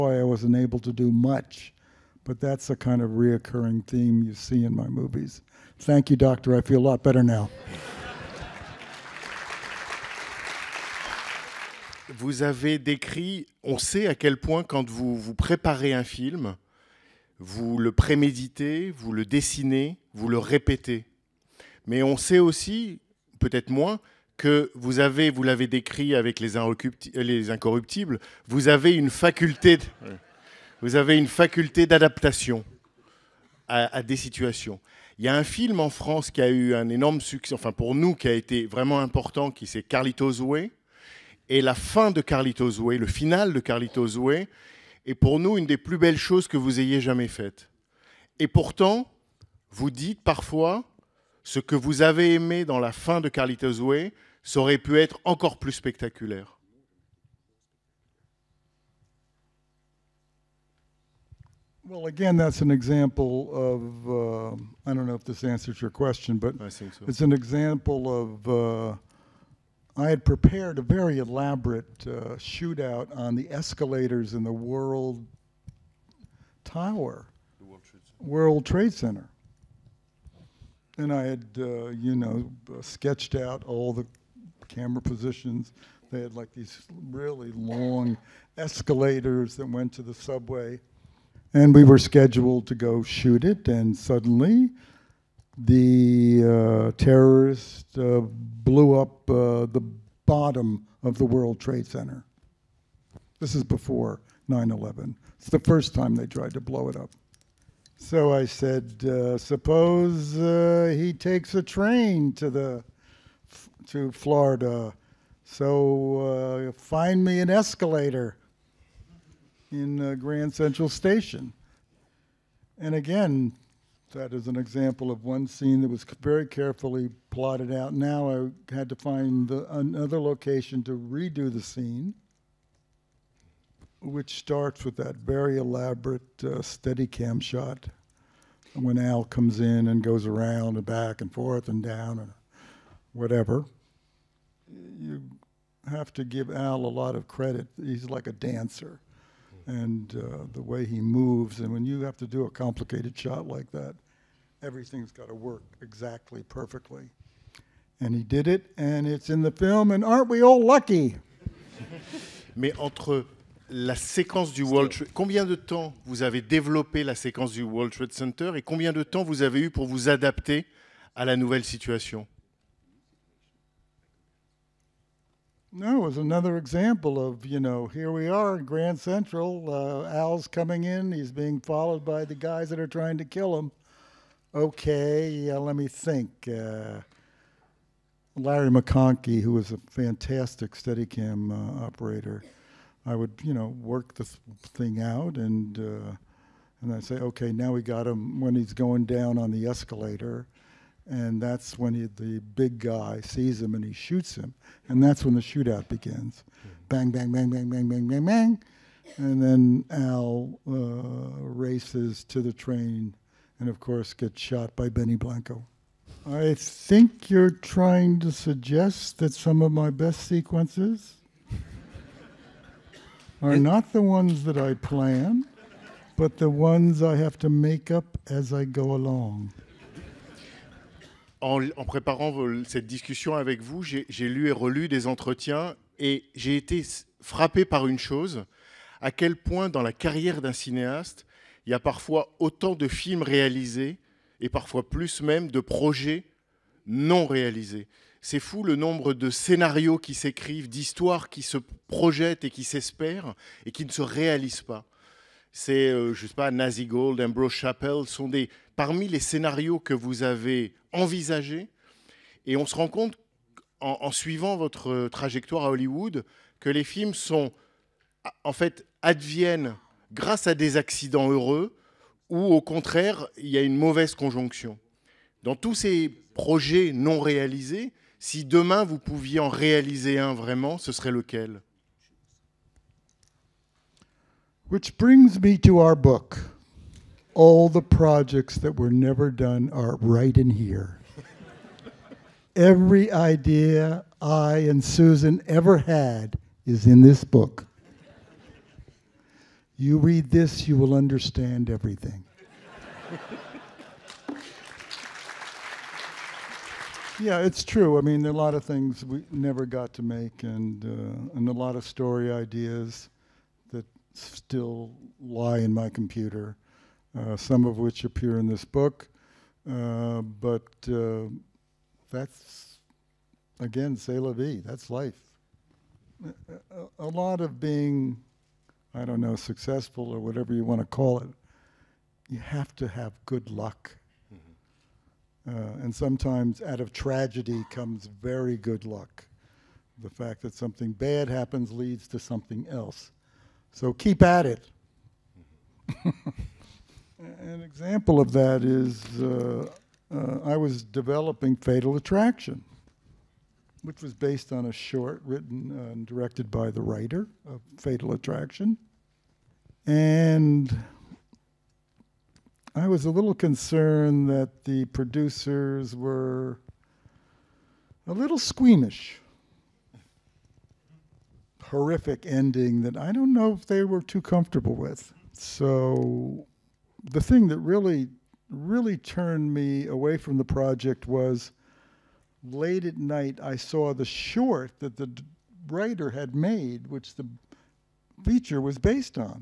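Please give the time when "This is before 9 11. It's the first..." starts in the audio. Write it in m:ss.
1:43.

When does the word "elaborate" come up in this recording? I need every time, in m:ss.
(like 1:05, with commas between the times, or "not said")
1:11, 2:15.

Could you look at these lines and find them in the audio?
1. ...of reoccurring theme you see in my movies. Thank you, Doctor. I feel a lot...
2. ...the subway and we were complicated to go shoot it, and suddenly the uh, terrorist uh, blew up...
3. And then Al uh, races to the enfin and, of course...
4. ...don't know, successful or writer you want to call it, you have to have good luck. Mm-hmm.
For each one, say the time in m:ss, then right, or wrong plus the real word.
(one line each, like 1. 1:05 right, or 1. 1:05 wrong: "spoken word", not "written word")
1. 0:03 right
2. 1:30 wrong: "scheduled", not "complicated"
3. 3:29 wrong: "train", not "enfin"
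4. 5:29 wrong: "whatever", not "writer".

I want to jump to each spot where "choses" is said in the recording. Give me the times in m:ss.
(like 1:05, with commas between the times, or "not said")
0:46, 3:57.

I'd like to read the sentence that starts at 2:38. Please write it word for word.
And he did it, and it's in the film, and aren't we all lucky?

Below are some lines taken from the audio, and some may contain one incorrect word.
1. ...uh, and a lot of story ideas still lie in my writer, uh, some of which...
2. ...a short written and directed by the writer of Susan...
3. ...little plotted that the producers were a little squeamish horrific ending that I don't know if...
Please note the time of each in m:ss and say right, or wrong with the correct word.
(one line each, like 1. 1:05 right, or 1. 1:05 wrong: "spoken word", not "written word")
1. 5:10 wrong: "computer", not "writer"
2. 5:54 wrong: "Fatal", not "Susan"
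3. 6:03 wrong: "concerned", not "plotted".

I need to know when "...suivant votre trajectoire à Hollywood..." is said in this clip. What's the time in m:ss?
4:24.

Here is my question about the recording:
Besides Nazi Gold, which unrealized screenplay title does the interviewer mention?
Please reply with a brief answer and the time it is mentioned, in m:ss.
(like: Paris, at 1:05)
Ambrose Chappell, at 4:17.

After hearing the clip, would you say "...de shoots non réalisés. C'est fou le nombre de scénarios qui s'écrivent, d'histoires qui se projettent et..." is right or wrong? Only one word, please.
wrong.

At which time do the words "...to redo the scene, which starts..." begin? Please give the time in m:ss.
2:10.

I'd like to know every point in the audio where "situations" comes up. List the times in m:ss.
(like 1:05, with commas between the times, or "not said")
0:34, 2:51.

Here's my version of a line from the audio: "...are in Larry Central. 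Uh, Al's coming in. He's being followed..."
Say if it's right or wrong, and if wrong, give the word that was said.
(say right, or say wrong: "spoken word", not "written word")
wrong: "Grand", not "Larry".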